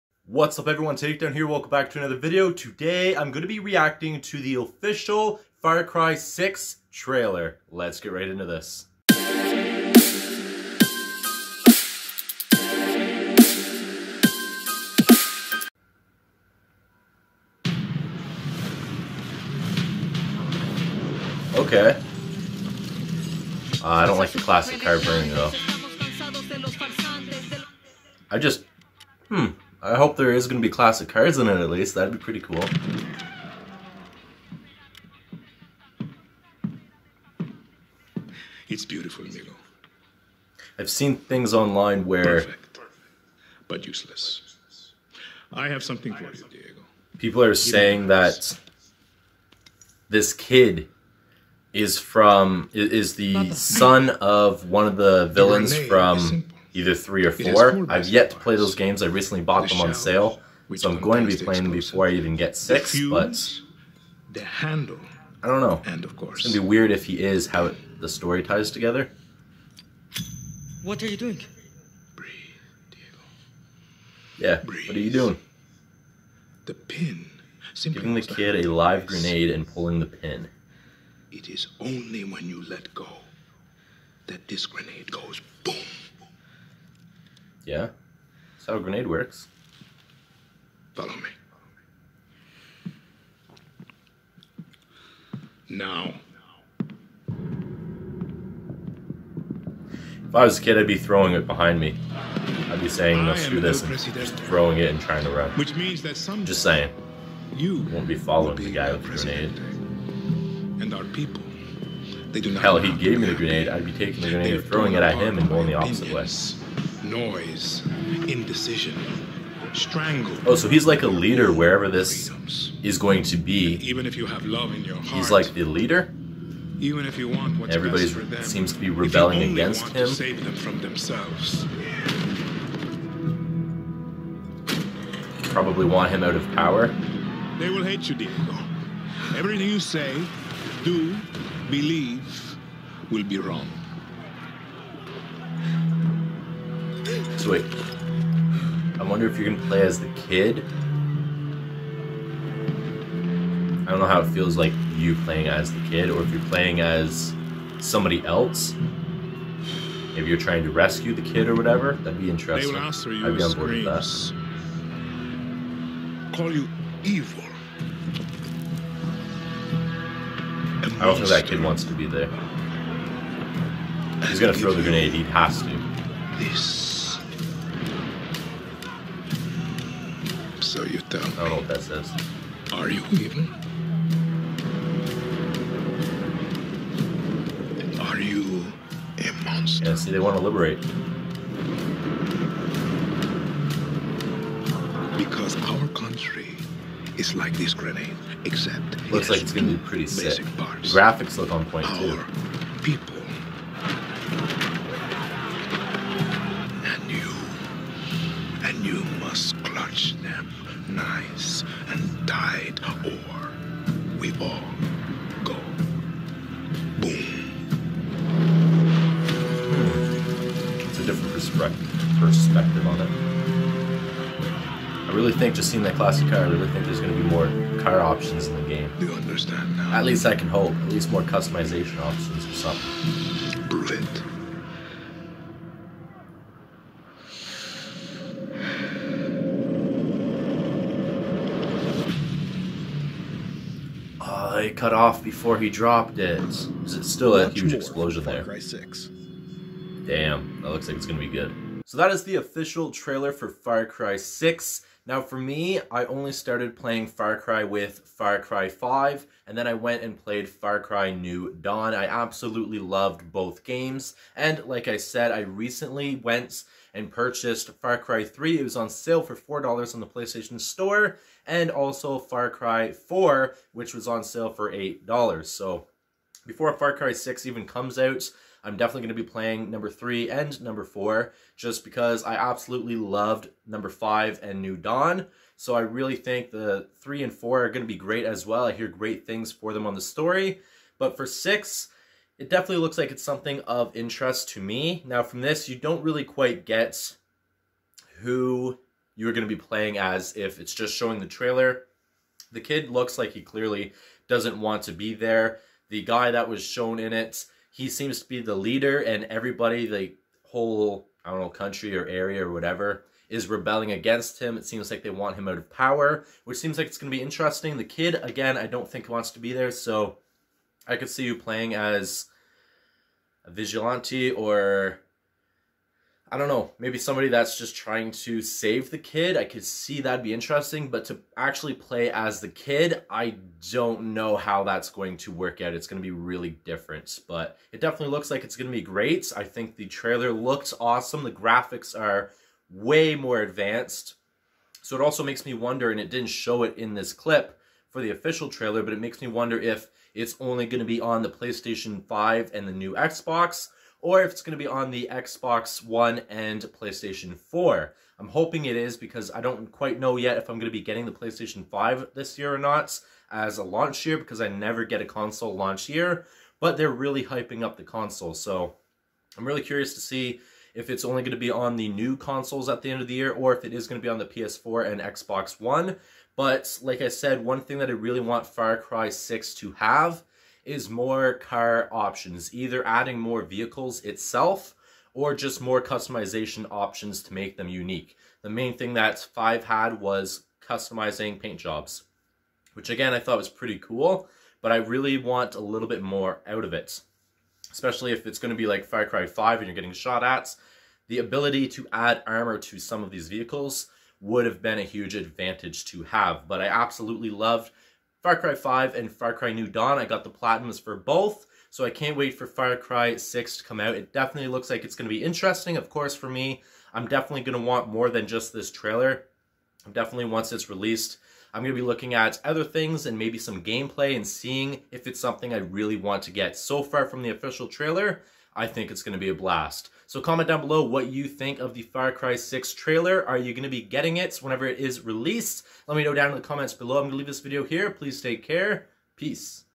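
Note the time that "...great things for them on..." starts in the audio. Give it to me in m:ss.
4:48.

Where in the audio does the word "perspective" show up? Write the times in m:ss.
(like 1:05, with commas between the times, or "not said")
3:42.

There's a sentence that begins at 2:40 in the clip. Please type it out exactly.
Maybe you're trying to rescue the kid or whatever.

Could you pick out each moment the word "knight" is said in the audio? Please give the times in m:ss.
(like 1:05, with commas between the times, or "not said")
not said.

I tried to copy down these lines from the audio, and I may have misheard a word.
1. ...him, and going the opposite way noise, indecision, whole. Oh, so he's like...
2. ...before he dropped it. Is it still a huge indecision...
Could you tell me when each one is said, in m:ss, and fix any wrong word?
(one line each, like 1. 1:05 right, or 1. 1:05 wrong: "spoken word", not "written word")
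1. 1:55 wrong: "strangle", not "whole"
2. 4:05 wrong: "explosion", not "indecision".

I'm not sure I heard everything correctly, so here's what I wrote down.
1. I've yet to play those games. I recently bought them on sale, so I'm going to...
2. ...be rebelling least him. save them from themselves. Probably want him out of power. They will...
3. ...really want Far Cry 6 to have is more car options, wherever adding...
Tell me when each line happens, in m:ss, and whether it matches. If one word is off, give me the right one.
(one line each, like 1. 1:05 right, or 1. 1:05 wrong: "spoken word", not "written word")
1. 0:57 right
2. 2:08 wrong: "against", not "least"
3. 6:17 wrong: "either", not "wherever".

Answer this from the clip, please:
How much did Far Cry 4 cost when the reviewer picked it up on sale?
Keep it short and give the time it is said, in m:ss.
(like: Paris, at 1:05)
$8, at 4:34.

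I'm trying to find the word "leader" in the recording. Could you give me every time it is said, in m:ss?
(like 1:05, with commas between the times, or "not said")
2:01, 2:05, 5:08.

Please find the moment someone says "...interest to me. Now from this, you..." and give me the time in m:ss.
4:53.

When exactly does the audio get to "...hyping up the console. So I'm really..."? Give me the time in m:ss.
6:07.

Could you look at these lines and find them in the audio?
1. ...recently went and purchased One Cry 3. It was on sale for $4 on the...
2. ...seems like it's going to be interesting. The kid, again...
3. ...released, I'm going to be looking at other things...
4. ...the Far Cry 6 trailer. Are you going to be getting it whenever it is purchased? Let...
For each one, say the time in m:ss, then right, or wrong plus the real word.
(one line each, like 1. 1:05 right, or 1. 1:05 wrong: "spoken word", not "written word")
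1. 4:25 wrong: "Far", not "One"
2. 5:16 right
3. 7:00 right
4. 7:11 wrong: "released", not "purchased".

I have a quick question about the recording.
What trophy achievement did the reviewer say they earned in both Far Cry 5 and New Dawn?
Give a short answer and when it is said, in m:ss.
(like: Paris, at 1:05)
Platinums, at 6:50.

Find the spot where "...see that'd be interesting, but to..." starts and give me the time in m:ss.
5:29.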